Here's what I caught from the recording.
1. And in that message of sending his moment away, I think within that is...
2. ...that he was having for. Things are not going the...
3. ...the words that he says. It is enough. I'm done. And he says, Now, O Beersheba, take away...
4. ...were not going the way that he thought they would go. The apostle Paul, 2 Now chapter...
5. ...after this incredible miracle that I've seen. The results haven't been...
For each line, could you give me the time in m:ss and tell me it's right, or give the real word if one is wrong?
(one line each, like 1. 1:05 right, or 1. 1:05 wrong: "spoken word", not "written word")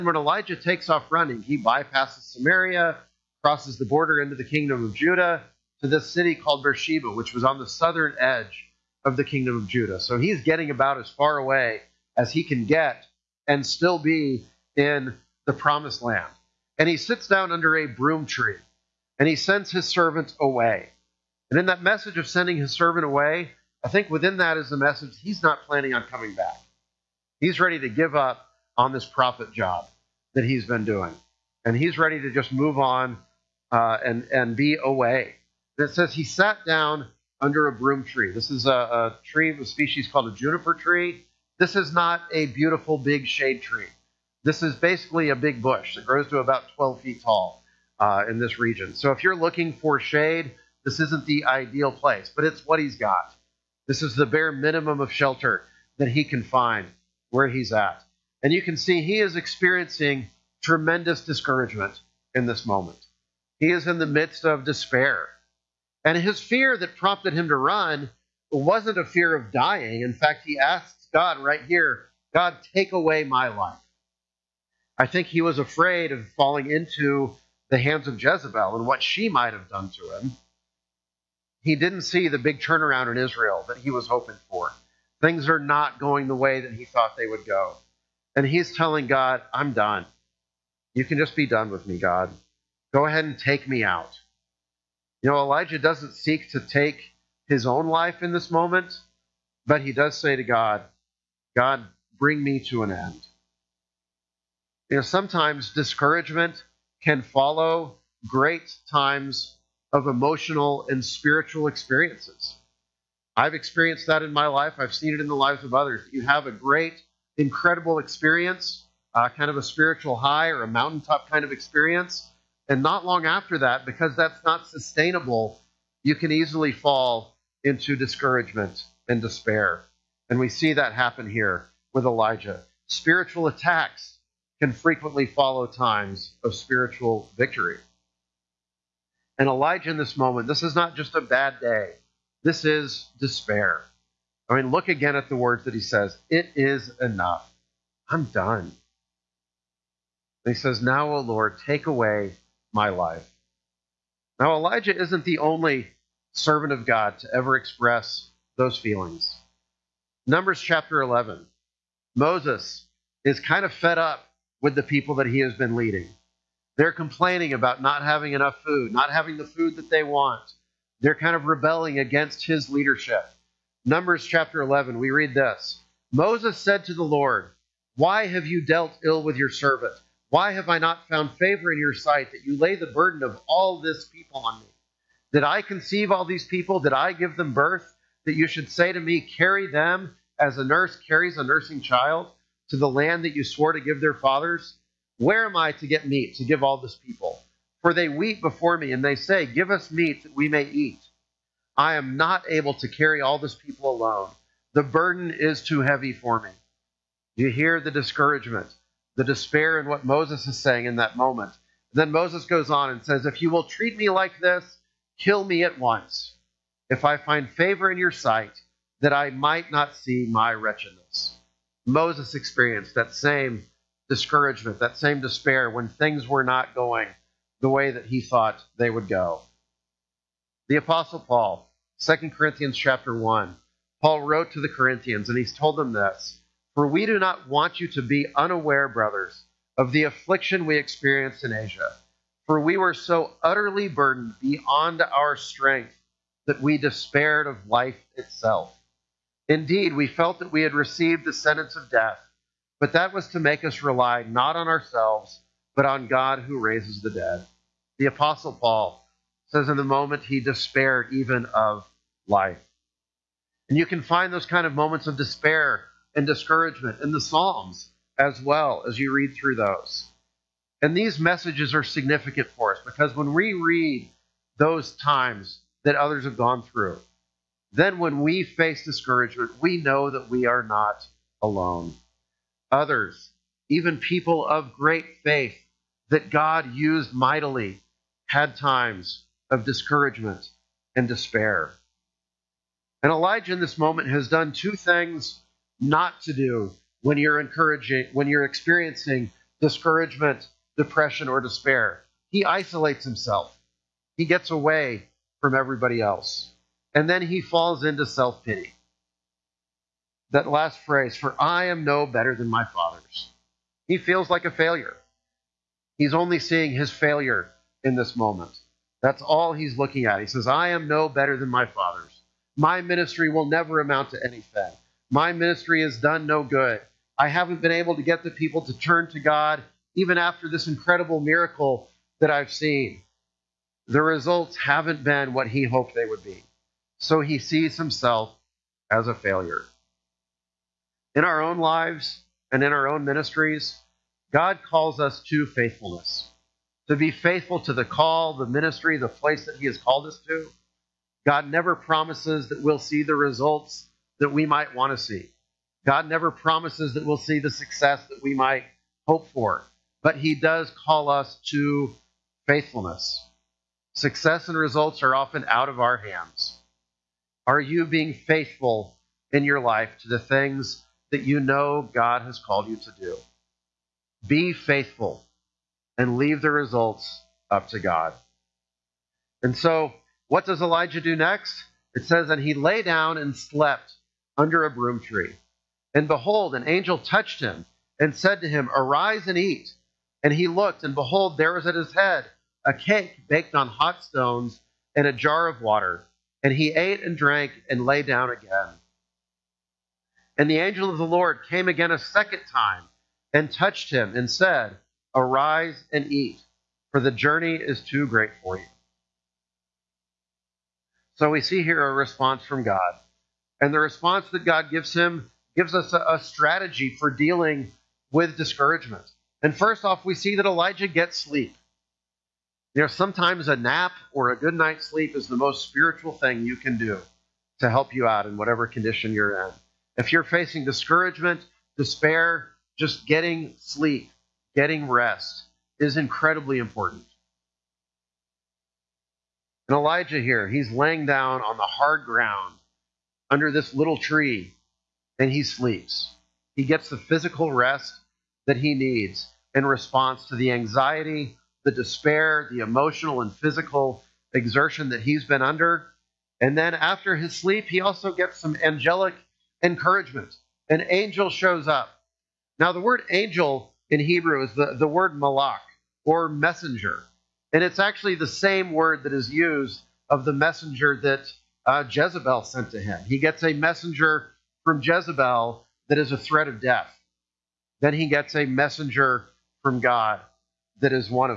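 1. 0:21 wrong: "servant", not "moment"
2. 1:23 wrong: "hoping", not "having"
3. 2:25 wrong: "Lord", not "Beersheba"
4. 3:46 wrong: "Corinthians", not "Now"
5. 5:30 right.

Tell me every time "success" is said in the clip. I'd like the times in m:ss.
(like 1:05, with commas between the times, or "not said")
5:57, 6:03.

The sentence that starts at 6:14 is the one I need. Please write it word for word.
Be faithful and leave the results up to God.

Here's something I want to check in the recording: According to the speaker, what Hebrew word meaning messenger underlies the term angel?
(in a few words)
malach.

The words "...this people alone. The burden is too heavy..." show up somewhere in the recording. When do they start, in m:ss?
3:23.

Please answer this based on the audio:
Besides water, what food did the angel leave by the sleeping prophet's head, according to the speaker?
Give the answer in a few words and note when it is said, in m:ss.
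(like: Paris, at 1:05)
a cake baked on hot stones, at 6:32.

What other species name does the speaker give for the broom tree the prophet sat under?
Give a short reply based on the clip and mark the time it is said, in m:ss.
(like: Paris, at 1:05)
juniper tree, at 0:40.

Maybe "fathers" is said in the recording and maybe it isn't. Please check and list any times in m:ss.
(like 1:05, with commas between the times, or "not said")
3:14, 5:12, 5:21.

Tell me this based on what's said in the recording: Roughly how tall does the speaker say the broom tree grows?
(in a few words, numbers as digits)
12 feet.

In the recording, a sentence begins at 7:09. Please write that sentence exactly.
If you're facing discouragement, despair, just getting sleep, getting rest is incredibly important.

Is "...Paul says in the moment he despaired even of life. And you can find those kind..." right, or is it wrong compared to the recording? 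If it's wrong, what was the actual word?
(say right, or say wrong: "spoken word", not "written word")
right.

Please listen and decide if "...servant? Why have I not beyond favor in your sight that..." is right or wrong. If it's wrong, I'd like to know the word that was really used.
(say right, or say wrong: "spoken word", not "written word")
wrong: "found", not "beyond".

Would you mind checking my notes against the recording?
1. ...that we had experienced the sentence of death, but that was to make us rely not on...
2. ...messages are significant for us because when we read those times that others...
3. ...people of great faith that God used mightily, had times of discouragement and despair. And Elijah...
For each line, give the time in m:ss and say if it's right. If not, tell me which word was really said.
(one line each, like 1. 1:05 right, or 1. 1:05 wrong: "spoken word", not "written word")
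1. 4:10 wrong: "received", not "experienced"
2. 4:31 right
3. 4:43 right.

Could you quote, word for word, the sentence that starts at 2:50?
They're kind of rebelling against his leadership.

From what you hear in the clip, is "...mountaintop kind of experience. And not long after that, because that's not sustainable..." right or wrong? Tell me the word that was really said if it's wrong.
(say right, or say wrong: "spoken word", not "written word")
right.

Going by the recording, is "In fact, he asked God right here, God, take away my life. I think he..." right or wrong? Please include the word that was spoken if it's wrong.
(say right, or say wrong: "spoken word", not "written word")
right.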